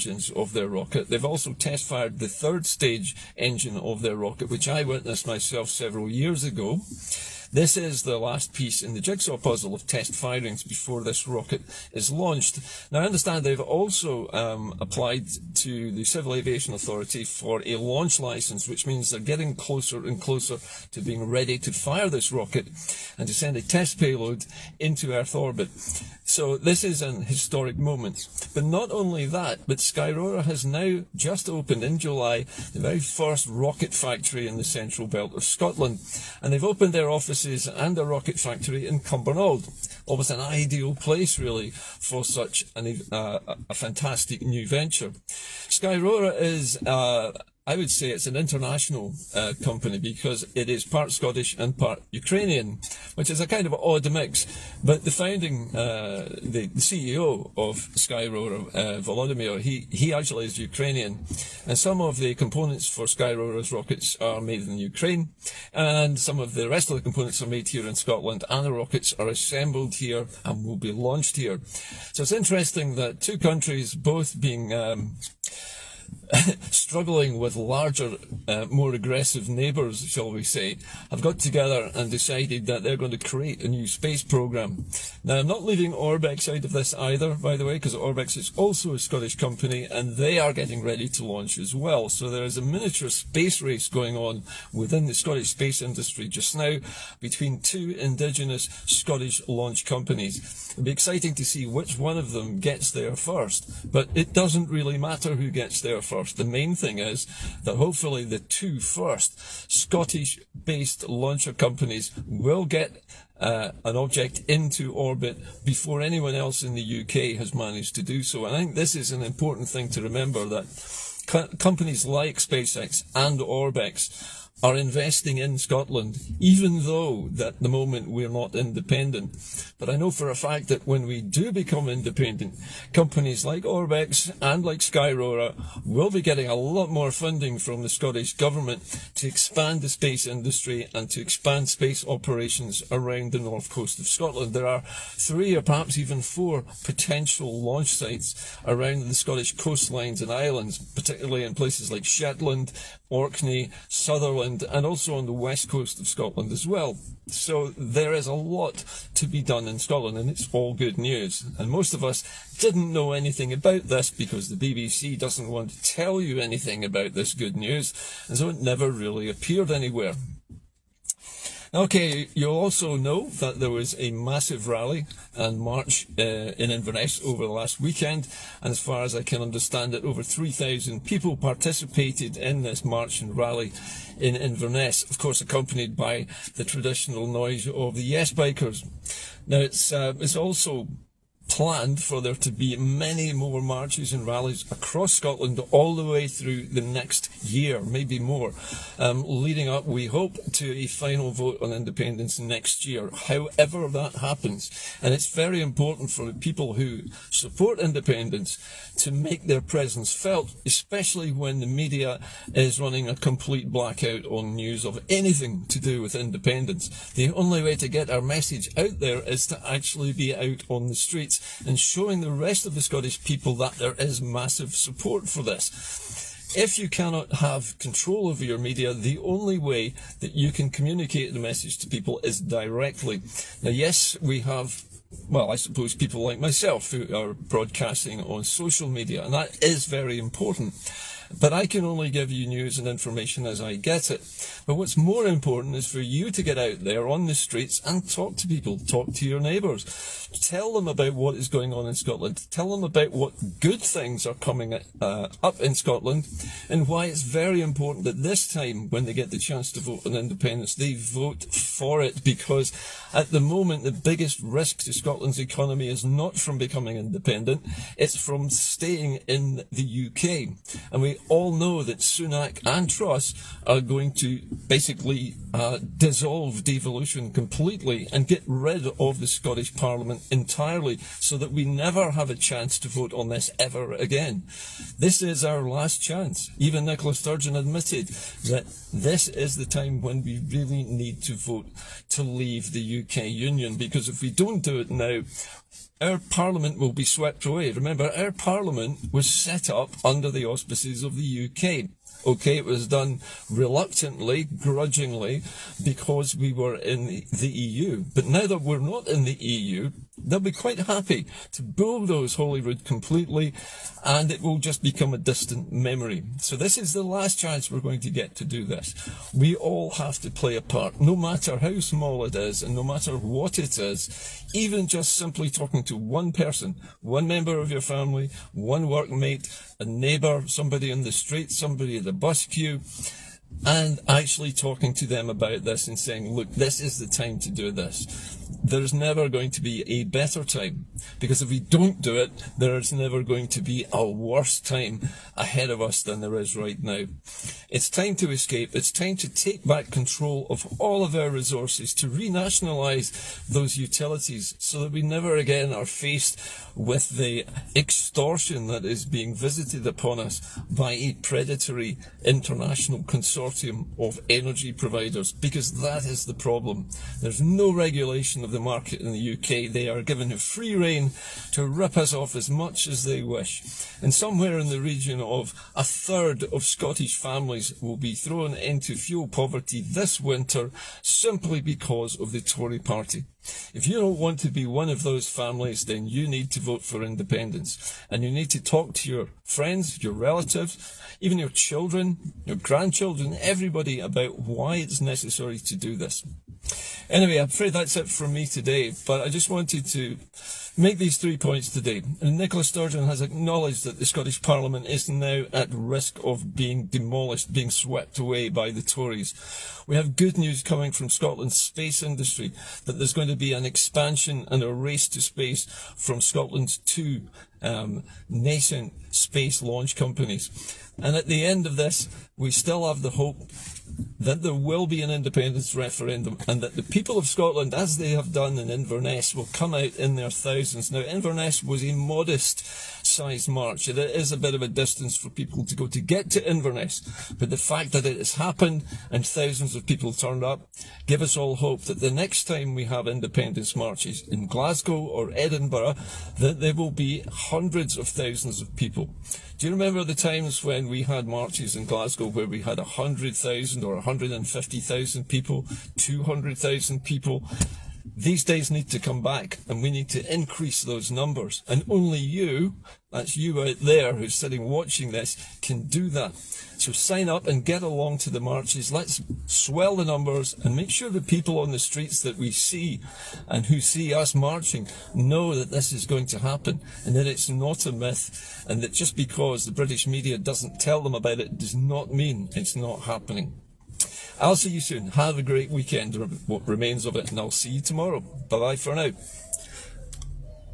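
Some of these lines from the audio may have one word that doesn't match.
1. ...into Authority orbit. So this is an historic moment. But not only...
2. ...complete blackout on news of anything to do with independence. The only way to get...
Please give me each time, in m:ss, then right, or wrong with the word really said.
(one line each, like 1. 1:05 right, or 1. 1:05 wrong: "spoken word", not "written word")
1. 0:24 wrong: "Earth", not "Authority"
2. 3:33 right.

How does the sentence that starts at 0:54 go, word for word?
But the founding, uh, the, the, CEO of Skyrora, uh, Volodymyr, he, he actually is Ukrainian.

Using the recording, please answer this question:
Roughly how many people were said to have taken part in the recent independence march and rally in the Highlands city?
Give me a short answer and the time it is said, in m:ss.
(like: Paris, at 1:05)
over 3,000, at 3:00.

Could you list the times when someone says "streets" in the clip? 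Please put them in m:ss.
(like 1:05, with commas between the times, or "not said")
3:40, 4:07, 5:31, 7:51.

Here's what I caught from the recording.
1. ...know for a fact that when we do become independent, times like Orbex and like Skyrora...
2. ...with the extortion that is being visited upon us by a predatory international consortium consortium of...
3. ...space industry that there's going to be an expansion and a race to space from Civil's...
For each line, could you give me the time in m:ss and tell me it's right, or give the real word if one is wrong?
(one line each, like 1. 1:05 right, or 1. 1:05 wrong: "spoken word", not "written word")
1. 2:09 wrong: "companies", not "times"
2. 5:56 right
3. 6:51 wrong: "Scotland", not "Civil".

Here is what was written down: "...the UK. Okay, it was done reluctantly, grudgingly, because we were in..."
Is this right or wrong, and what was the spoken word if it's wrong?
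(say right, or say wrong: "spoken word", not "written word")
right.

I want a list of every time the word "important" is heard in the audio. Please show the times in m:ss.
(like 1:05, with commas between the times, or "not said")
1:59, 3:25, 4:00, 4:05, 4:17.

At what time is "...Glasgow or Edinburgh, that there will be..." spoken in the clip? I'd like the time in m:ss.
7:24.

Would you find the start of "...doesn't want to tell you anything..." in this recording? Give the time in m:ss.
2:45.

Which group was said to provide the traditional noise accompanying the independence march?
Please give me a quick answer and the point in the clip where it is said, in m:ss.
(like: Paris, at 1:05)
Yes Bikers, at 3:08.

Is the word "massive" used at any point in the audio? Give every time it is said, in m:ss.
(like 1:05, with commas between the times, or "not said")
2:54, 3:44.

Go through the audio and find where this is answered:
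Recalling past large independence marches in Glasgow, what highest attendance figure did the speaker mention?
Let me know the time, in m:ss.
7:35.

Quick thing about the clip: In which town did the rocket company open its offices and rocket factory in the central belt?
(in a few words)
Cumbernauld.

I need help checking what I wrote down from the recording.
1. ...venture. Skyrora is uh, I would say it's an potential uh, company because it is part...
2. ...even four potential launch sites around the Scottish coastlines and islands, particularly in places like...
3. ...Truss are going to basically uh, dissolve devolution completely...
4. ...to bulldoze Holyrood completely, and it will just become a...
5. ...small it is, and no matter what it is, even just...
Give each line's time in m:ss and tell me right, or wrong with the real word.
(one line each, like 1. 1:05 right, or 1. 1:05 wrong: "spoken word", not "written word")
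1. 0:44 wrong: "international", not "potential"
2. 2:25 right
3. 4:32 right
4. 5:11 right
5. 5:21 right.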